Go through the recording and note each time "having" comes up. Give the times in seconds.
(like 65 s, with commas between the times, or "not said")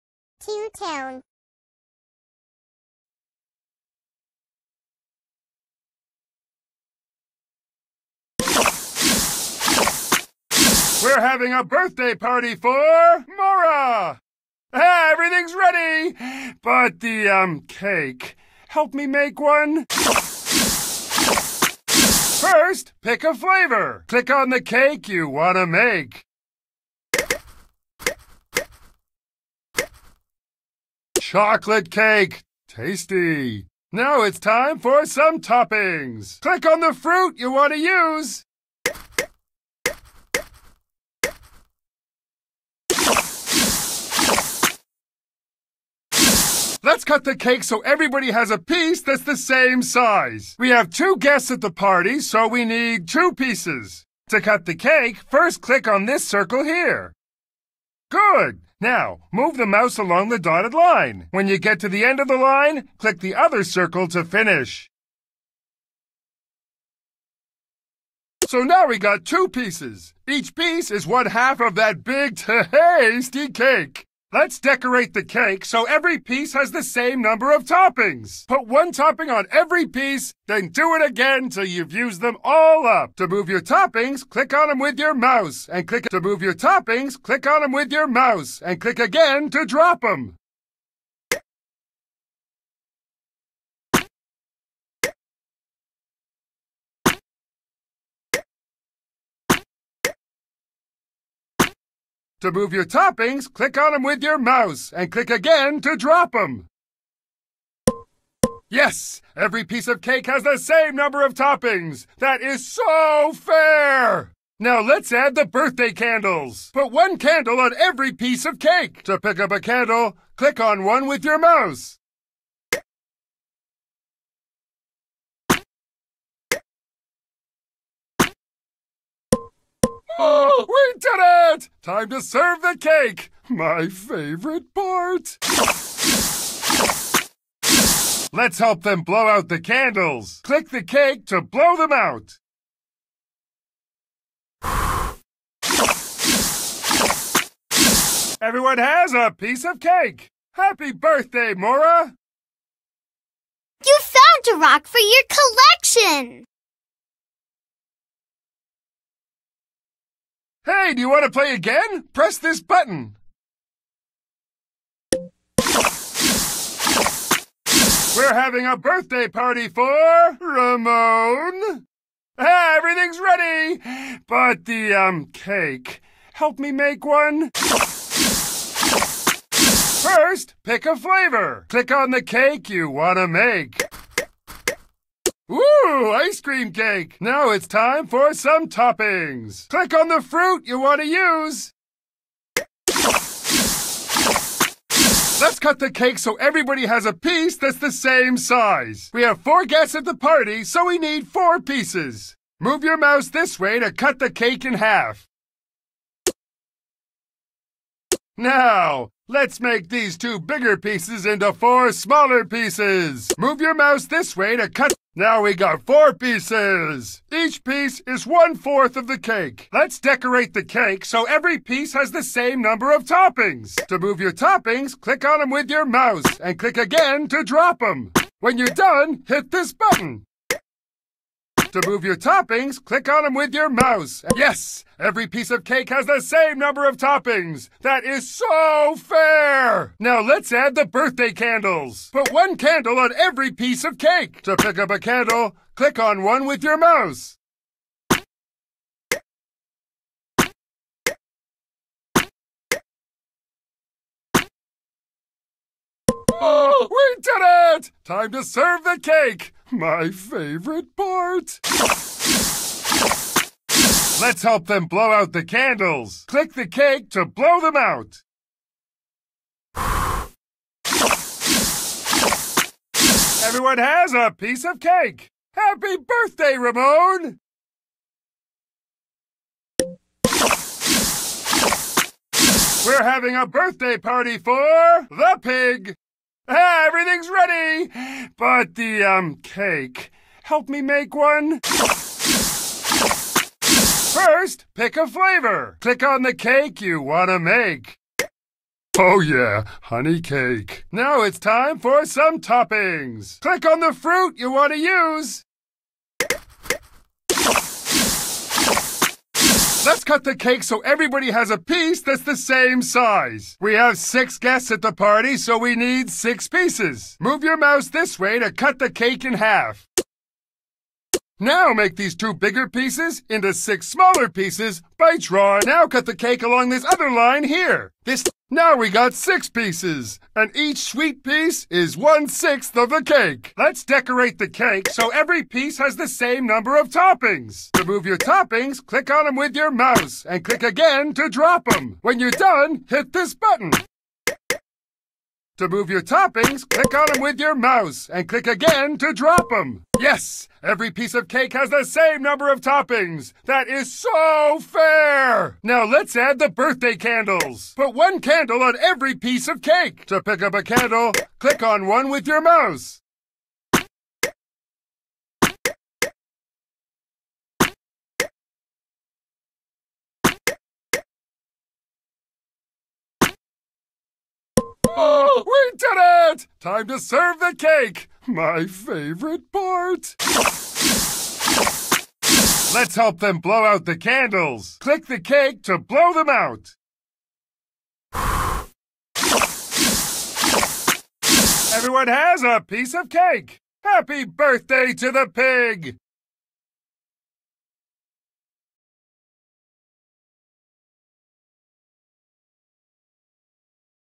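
11 s, 168 s, 283 s.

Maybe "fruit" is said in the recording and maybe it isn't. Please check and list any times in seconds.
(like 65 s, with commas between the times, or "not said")
36 s, 190 s, 303 s.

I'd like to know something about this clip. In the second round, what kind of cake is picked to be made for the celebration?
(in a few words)
Ice cream cake.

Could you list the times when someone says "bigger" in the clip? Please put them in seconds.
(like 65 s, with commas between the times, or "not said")
210 s, 322 s.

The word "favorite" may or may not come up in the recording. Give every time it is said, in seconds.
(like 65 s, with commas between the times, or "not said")
133 s, 260 s, 378 s.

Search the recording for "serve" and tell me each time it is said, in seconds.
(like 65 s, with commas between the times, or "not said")
132 s, 258 s, 376 s.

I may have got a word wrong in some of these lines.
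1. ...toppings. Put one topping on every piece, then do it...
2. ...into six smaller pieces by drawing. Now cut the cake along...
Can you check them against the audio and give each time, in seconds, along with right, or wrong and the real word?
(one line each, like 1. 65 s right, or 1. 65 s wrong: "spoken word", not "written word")
1. 77 s right
2. 323 s right.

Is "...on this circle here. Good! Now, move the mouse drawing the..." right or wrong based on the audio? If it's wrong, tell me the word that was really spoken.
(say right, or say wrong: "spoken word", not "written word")
wrong: "along", not "drawing".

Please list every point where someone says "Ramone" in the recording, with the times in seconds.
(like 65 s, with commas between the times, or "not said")
170 s, 276 s.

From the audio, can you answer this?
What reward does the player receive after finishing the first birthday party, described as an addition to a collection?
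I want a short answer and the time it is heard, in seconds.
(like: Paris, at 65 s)
A rock, at 154 s.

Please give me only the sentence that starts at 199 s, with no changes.
We have four guests at the party, so we need four pieces.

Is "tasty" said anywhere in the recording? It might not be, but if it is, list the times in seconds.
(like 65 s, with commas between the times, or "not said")
32 s, 72 s.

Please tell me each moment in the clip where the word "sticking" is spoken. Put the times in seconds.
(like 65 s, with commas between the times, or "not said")
not said.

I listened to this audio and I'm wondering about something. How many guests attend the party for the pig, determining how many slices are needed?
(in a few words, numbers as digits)
6.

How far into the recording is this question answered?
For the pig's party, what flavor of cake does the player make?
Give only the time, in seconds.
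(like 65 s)
299 s.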